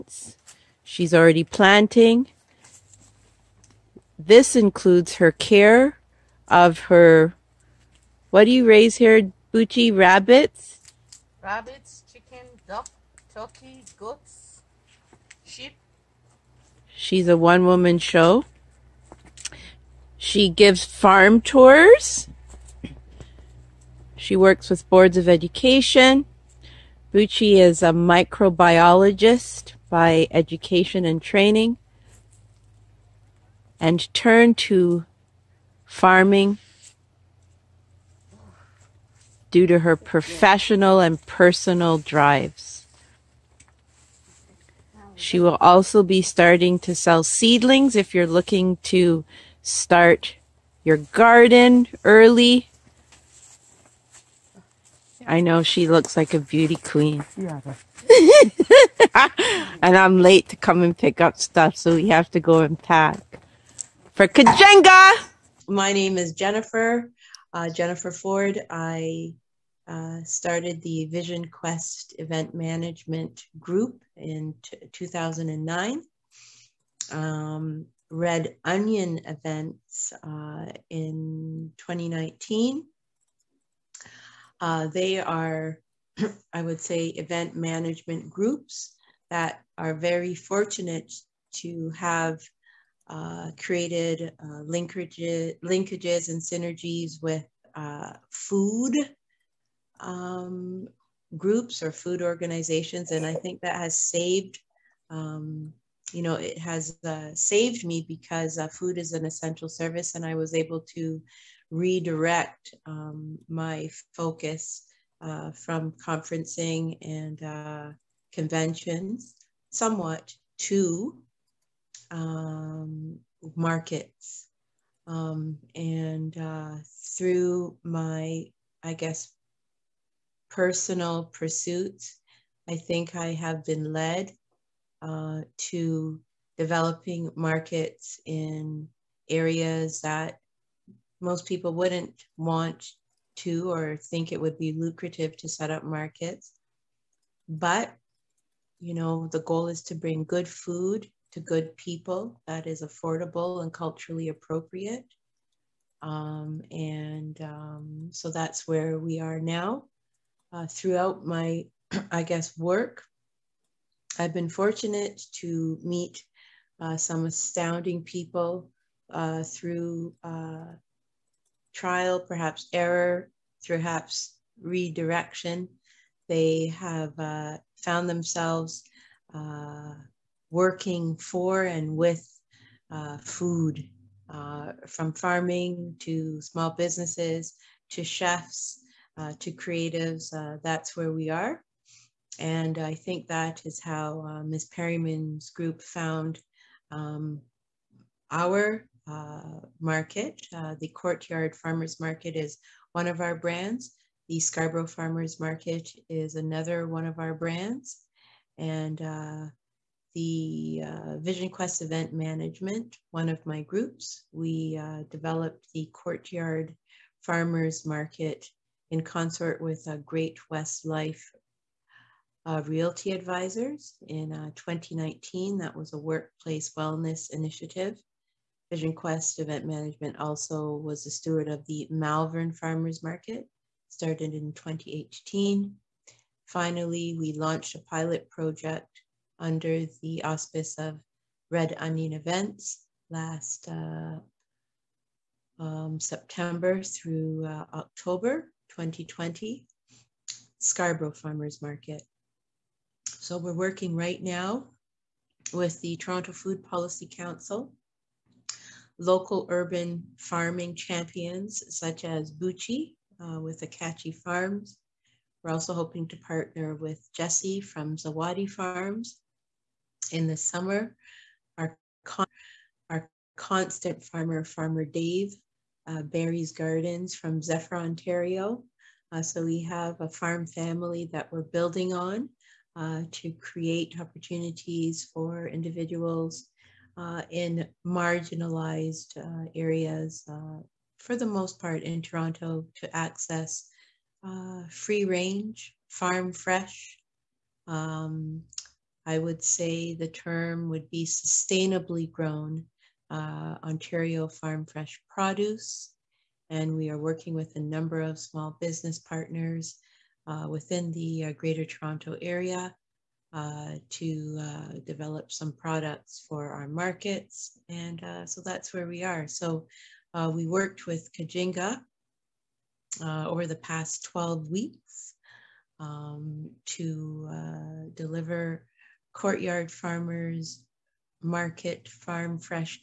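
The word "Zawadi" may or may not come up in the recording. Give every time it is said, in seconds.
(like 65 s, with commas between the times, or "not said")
267 s.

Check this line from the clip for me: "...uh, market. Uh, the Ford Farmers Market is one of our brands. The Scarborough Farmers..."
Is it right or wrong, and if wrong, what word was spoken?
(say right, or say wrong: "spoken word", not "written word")
wrong: "Courtyard", not "Ford".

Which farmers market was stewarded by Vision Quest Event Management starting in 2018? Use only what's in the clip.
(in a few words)
Malvern Farmers Market.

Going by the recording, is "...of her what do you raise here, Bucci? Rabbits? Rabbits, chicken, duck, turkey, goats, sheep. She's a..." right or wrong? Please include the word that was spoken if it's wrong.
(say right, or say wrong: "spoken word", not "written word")
right.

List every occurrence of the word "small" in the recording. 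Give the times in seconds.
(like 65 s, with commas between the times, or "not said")
186 s, 308 s.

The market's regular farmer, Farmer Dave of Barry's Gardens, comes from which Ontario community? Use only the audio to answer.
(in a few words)
Zephyr.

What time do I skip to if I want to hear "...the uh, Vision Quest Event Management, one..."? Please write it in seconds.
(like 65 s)
210 s.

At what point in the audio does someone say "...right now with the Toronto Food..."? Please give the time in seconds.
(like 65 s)
253 s.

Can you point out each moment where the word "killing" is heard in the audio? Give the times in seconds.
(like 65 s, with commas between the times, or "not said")
not said.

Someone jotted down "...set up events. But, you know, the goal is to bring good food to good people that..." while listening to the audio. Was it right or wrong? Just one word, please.
wrong.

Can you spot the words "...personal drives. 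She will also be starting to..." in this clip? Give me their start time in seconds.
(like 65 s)
41 s.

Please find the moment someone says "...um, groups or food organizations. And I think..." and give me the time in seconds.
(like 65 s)
99 s.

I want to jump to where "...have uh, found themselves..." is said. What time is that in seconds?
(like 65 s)
176 s.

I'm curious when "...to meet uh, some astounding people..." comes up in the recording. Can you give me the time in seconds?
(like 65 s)
165 s.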